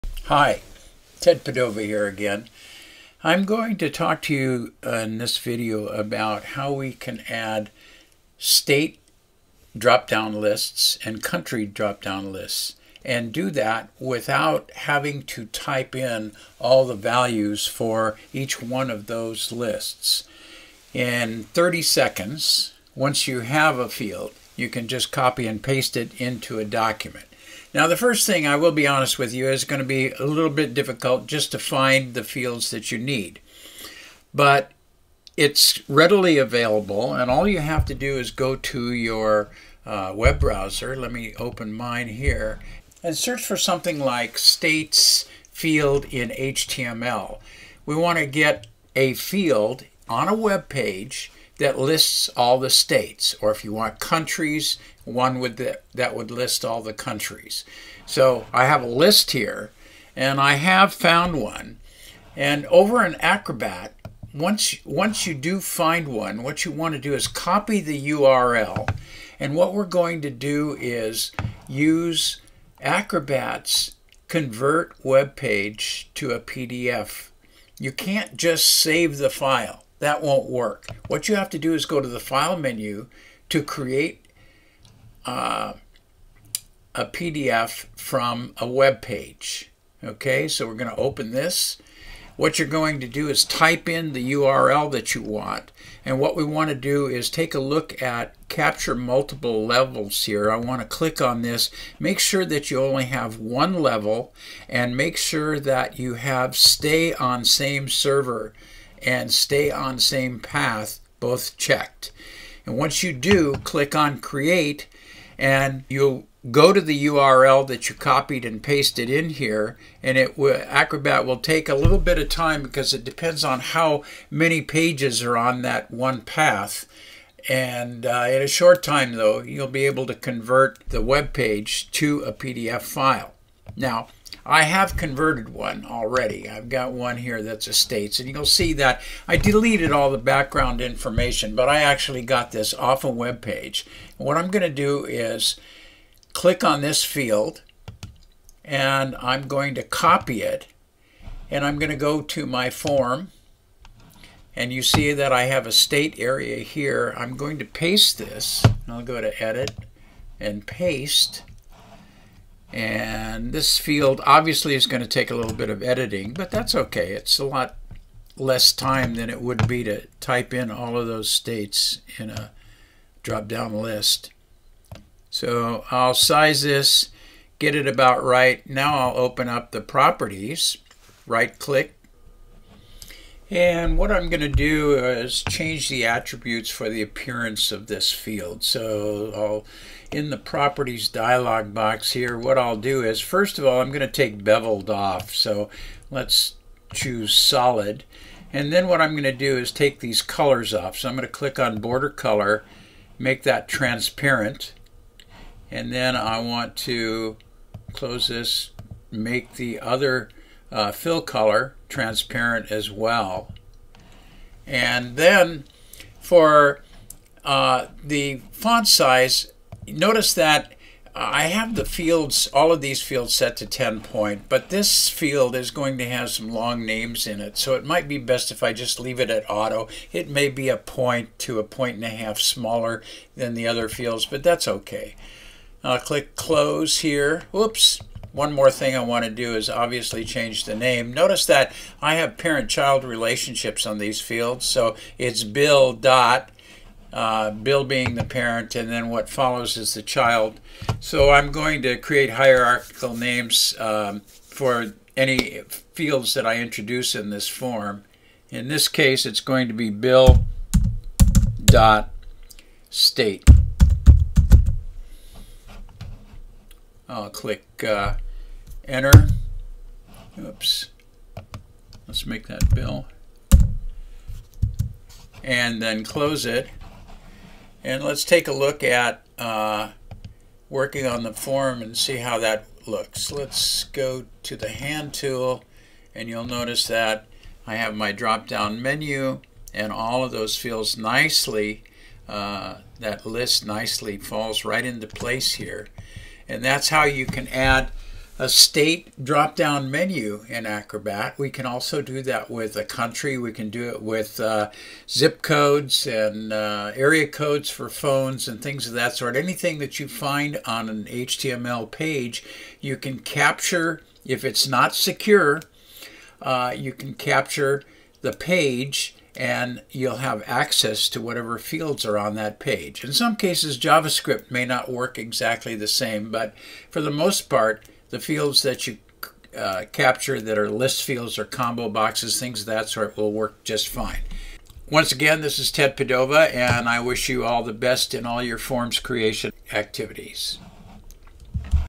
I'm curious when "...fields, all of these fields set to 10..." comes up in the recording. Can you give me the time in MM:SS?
03:41.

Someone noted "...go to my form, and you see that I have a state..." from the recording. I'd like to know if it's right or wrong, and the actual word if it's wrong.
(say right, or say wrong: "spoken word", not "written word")
right.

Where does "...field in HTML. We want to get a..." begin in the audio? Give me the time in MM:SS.
00:45.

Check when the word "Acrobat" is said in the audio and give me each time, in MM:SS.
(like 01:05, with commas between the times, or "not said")
01:03, 01:12, 02:00, 05:00.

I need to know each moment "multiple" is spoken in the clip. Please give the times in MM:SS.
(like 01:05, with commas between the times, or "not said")
01:38.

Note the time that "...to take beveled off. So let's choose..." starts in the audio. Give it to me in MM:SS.
03:13.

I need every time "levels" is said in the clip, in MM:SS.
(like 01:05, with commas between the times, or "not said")
01:39, 01:43.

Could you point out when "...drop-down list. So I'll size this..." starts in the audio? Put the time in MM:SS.
02:53.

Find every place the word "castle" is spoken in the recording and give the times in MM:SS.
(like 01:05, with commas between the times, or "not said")
not said.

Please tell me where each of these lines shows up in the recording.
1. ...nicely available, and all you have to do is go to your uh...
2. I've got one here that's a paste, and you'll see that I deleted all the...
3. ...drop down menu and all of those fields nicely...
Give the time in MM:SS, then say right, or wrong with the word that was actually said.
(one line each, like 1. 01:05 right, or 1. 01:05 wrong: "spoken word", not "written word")
1. 00:35 wrong: "readily", not "nicely"
2. 02:16 wrong: "state", not "paste"
3. 04:48 right.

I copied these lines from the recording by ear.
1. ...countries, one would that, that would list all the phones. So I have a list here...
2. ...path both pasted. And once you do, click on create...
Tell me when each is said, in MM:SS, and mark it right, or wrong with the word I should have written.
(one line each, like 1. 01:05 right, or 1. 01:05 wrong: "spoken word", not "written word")
1. 00:53 wrong: "countries", not "phones"
2. 01:50 wrong: "checked", not "pasted".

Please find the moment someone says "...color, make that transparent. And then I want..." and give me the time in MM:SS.
03:22.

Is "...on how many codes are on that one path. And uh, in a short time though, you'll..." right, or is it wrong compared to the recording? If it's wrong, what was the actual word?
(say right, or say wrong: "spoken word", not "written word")
wrong: "pages", not "codes".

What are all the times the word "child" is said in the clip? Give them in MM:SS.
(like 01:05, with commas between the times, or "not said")
04:02, 04:10.